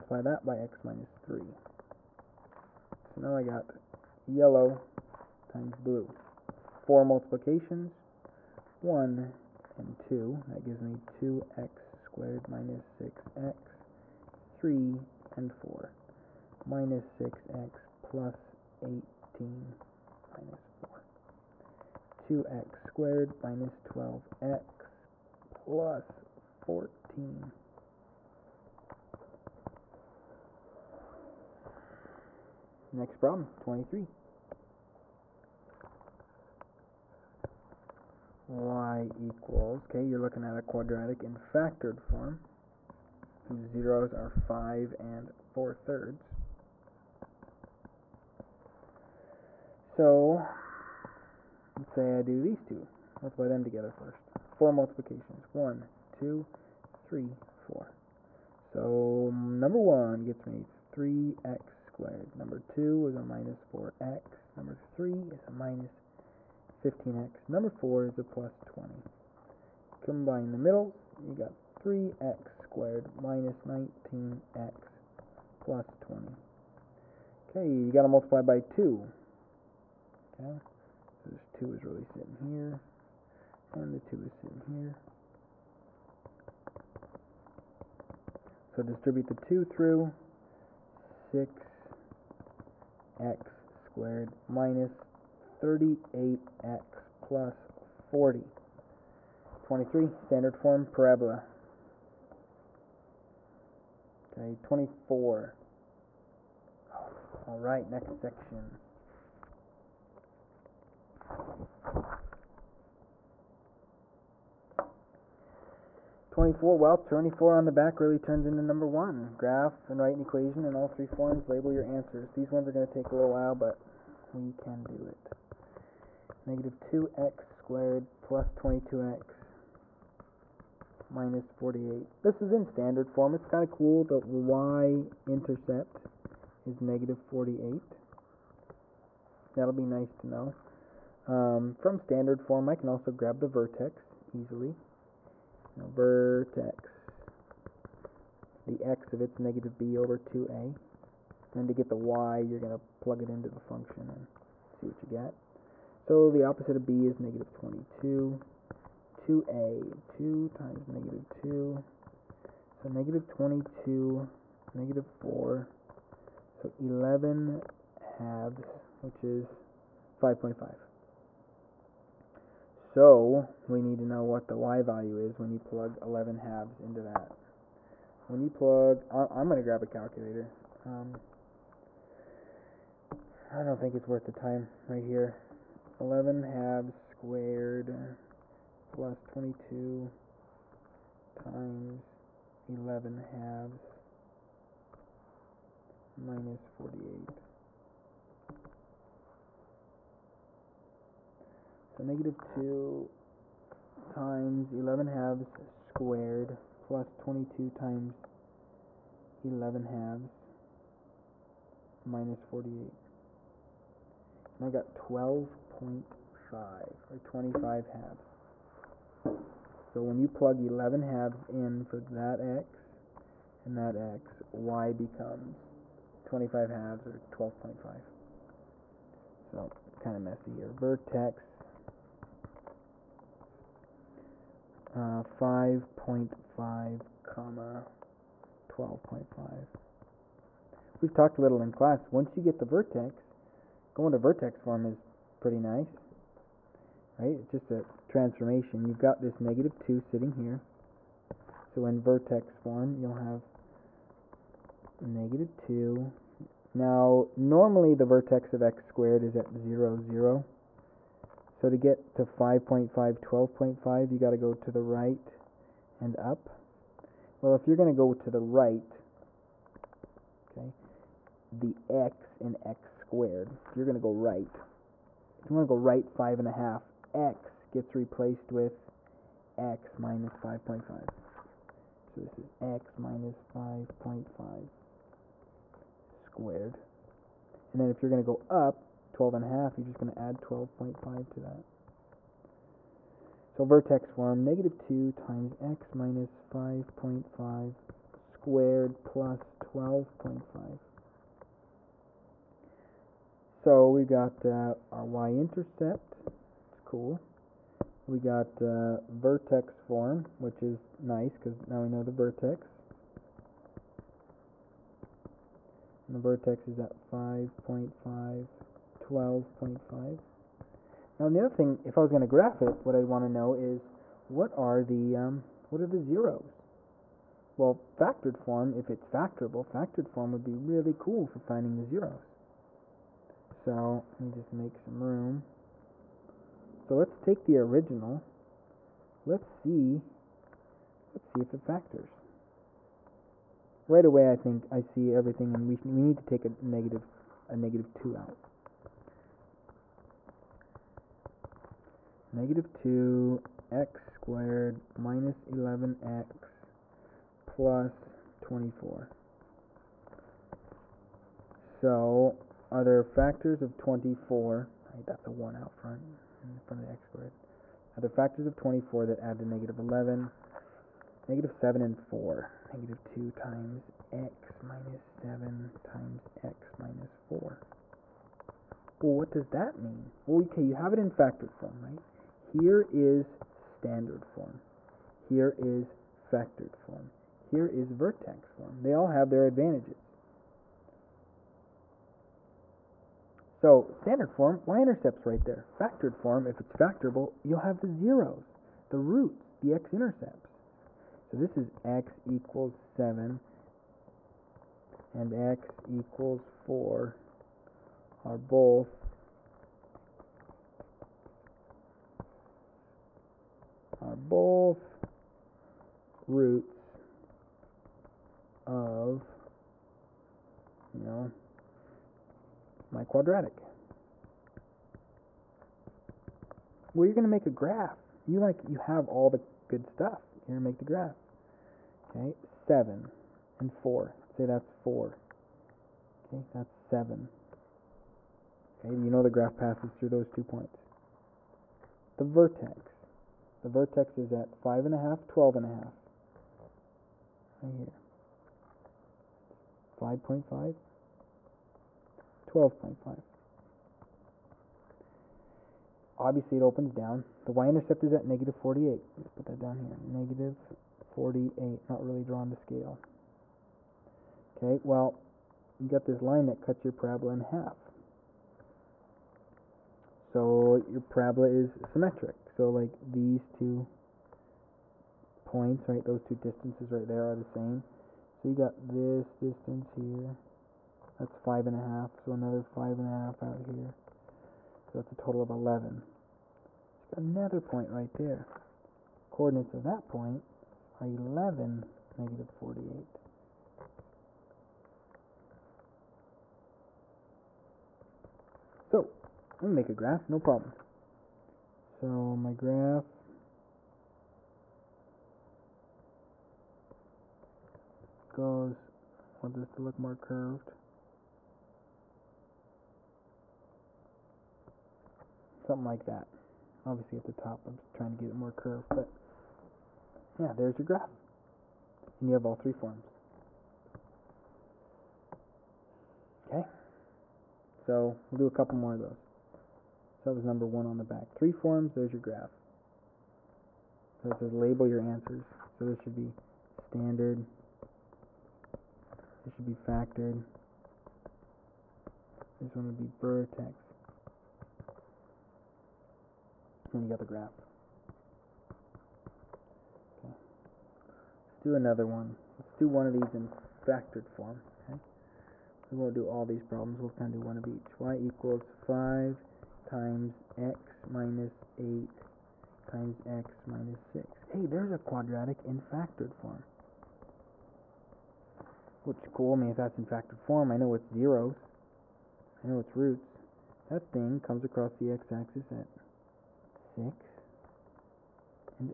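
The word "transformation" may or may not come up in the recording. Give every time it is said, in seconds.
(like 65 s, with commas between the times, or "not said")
248 s.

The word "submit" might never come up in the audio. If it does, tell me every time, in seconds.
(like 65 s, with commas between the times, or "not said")
not said.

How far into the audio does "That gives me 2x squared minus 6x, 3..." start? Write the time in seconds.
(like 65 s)
10 s.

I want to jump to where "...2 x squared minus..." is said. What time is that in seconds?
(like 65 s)
352 s.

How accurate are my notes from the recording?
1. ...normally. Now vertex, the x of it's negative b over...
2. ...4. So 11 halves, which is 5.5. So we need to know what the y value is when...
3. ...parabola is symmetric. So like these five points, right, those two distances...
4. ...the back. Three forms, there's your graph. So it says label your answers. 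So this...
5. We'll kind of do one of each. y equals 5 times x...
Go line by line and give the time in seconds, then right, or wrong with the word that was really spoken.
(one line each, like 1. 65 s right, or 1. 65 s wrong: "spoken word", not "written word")
1. 144 s wrong: "easily", not "normally"
2. 165 s right
3. 471 s wrong: "two", not "five"
4. 530 s right
5. 557 s right.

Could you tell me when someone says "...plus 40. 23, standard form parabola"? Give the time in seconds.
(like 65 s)
97 s.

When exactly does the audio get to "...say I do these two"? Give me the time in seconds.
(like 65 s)
51 s.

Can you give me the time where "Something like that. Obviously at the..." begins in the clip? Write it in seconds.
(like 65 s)
515 s.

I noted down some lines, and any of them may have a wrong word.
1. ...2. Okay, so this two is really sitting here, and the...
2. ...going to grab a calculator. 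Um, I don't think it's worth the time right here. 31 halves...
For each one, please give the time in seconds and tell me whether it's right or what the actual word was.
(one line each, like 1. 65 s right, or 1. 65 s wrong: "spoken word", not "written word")
1. 78 s right
2. 179 s wrong: "11", not "31".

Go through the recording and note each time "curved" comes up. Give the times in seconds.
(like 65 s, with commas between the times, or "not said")
510 s, 518 s.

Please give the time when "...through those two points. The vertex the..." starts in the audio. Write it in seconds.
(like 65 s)
439 s.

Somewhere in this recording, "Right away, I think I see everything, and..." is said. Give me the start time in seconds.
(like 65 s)
343 s.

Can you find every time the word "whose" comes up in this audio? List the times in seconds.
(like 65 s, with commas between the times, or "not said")
43 s.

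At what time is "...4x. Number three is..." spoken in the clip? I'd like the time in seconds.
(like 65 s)
63 s.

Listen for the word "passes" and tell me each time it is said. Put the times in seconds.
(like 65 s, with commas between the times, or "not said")
439 s.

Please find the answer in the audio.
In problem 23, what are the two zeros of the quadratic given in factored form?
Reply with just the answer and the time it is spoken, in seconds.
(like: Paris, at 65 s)
5 and 4/3, at 44 s.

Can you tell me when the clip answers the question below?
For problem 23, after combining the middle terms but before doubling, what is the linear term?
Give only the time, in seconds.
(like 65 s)
73 s.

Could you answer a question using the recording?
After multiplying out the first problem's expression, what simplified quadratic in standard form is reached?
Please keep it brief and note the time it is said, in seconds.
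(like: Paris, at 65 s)
2x^2 - 12x + 14, at 22 s.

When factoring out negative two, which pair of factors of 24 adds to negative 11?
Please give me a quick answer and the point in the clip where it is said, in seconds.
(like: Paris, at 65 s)
-7 and 4, at 371 s.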